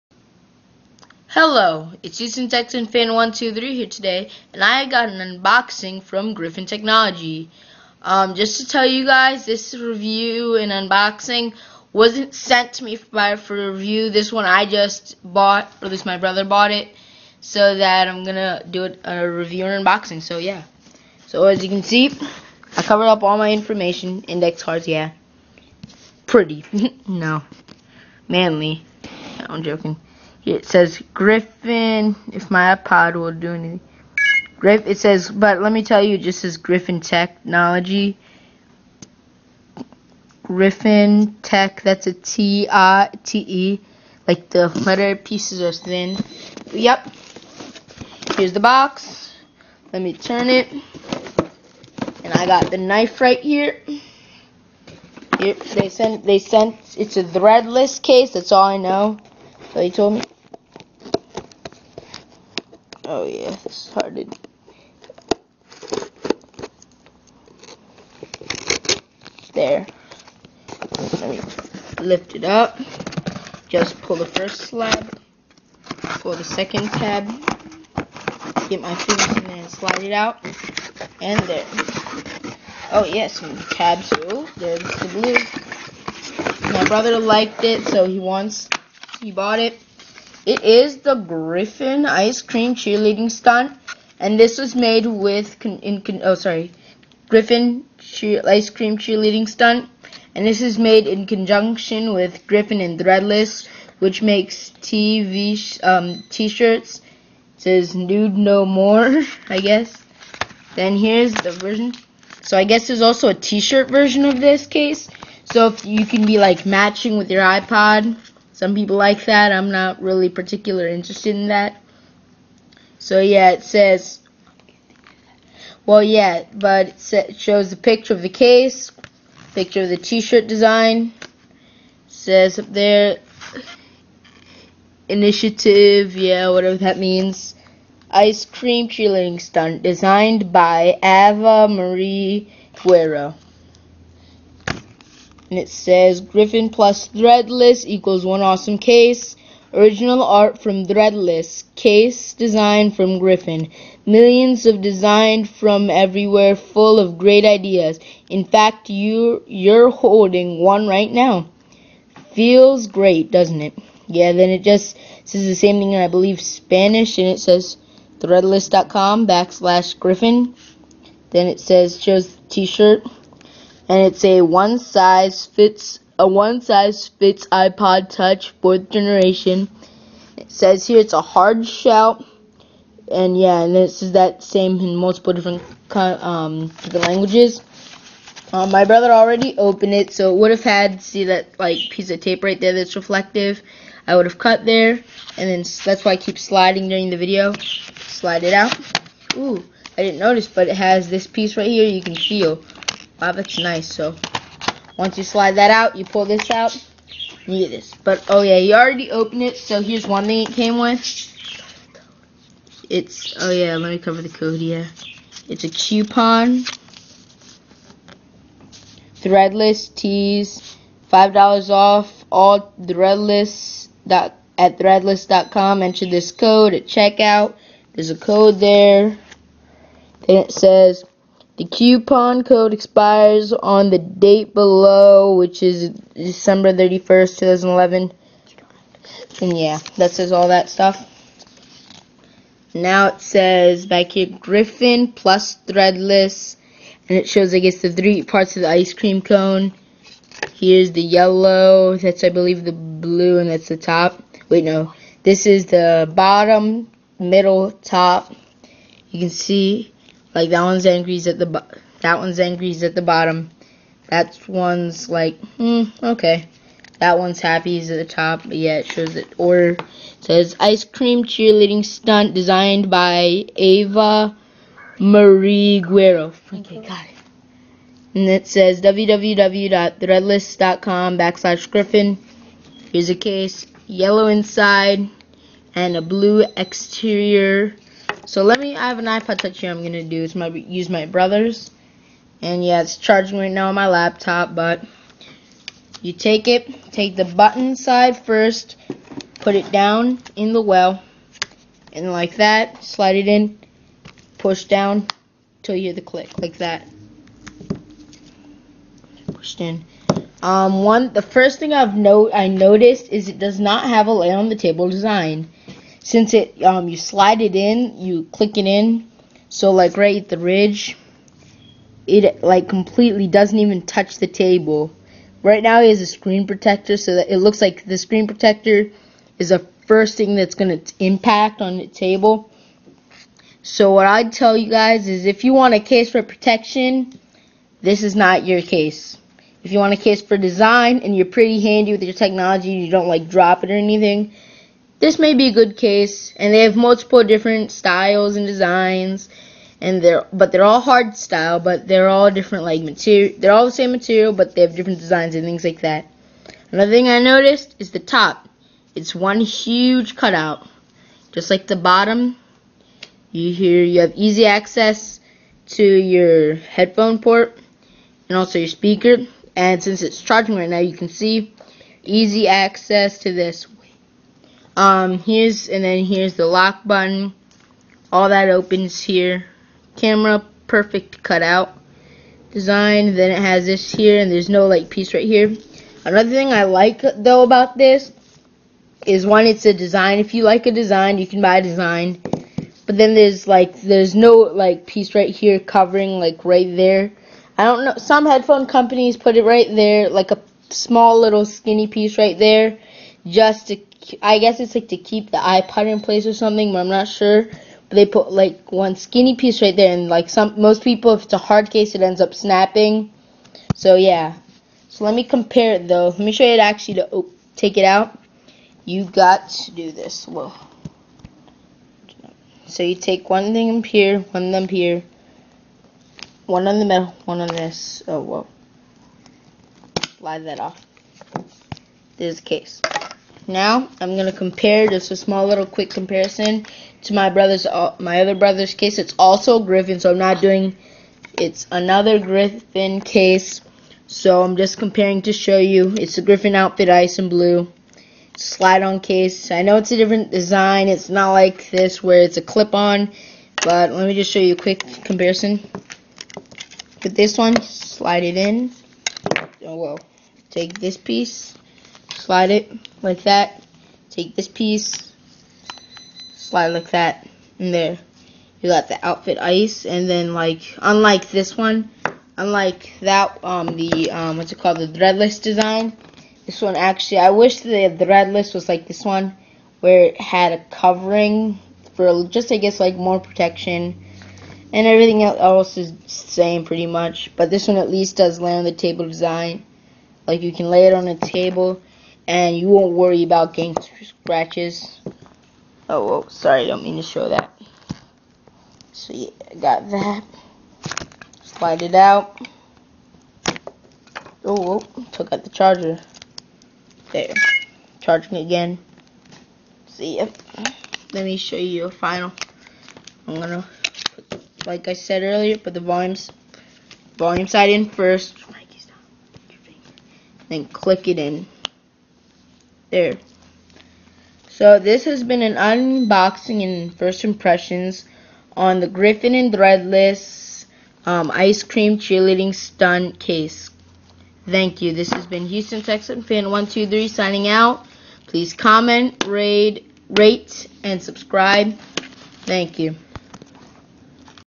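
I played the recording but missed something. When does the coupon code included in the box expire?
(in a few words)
December 31st, 2011.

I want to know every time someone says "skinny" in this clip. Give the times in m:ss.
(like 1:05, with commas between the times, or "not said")
6:41, 6:48.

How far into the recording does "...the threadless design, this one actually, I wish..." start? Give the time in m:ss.
7:54.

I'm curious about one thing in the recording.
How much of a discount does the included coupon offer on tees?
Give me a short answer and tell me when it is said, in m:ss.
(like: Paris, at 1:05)
$5, at 3:41.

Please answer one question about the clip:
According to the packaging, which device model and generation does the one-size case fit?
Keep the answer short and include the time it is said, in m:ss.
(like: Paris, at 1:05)
iPod Touch fourth generation, at 2:57.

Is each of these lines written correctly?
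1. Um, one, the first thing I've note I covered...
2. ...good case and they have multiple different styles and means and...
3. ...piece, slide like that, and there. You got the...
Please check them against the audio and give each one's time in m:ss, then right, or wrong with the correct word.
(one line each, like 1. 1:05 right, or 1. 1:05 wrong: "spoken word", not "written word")
1. 5:10 wrong: "noticed", not "covered"
2. 5:45 wrong: "designs", not "means"
3. 7:44 right.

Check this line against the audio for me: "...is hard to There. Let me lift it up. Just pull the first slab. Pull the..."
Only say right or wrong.
right.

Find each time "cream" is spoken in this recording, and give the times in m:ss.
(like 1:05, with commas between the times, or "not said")
1:32, 1:38, 2:18, 4:08, 4:30, 8:51.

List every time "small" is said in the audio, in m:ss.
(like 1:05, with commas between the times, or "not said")
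6:40, 7:15.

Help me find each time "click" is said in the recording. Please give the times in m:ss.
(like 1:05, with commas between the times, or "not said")
5:06, 5:18, 8:40.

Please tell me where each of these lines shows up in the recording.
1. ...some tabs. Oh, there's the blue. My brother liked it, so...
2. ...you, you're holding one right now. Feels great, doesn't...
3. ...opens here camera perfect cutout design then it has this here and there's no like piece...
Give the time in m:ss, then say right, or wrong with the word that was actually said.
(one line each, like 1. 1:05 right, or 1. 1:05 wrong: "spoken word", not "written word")
1. 1:23 right
2. 2:38 right
3. 6:18 right.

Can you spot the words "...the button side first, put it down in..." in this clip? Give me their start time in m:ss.
4:57.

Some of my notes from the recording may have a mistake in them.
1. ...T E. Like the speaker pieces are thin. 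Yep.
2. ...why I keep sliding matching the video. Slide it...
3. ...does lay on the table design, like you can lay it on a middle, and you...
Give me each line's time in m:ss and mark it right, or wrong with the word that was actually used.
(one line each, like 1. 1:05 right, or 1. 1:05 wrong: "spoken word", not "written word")
1. 0:43 wrong: "letter", not "speaker"
2. 3:16 wrong: "during", not "matching"
3. 8:08 wrong: "table", not "middle".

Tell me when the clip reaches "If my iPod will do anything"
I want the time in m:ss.
0:32.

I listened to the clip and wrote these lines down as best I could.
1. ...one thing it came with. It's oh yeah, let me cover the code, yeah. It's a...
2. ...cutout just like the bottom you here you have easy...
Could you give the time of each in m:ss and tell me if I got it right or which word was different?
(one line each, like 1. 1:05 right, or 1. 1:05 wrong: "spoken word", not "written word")
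1. 3:30 right
2. 6:00 right.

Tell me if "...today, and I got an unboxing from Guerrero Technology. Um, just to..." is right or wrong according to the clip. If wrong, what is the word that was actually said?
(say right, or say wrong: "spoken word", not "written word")
wrong: "Griffin", not "Guerrero".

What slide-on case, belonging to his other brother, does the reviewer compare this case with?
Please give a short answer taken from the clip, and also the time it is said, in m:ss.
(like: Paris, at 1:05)
Griffin outfit ice, at 7:26.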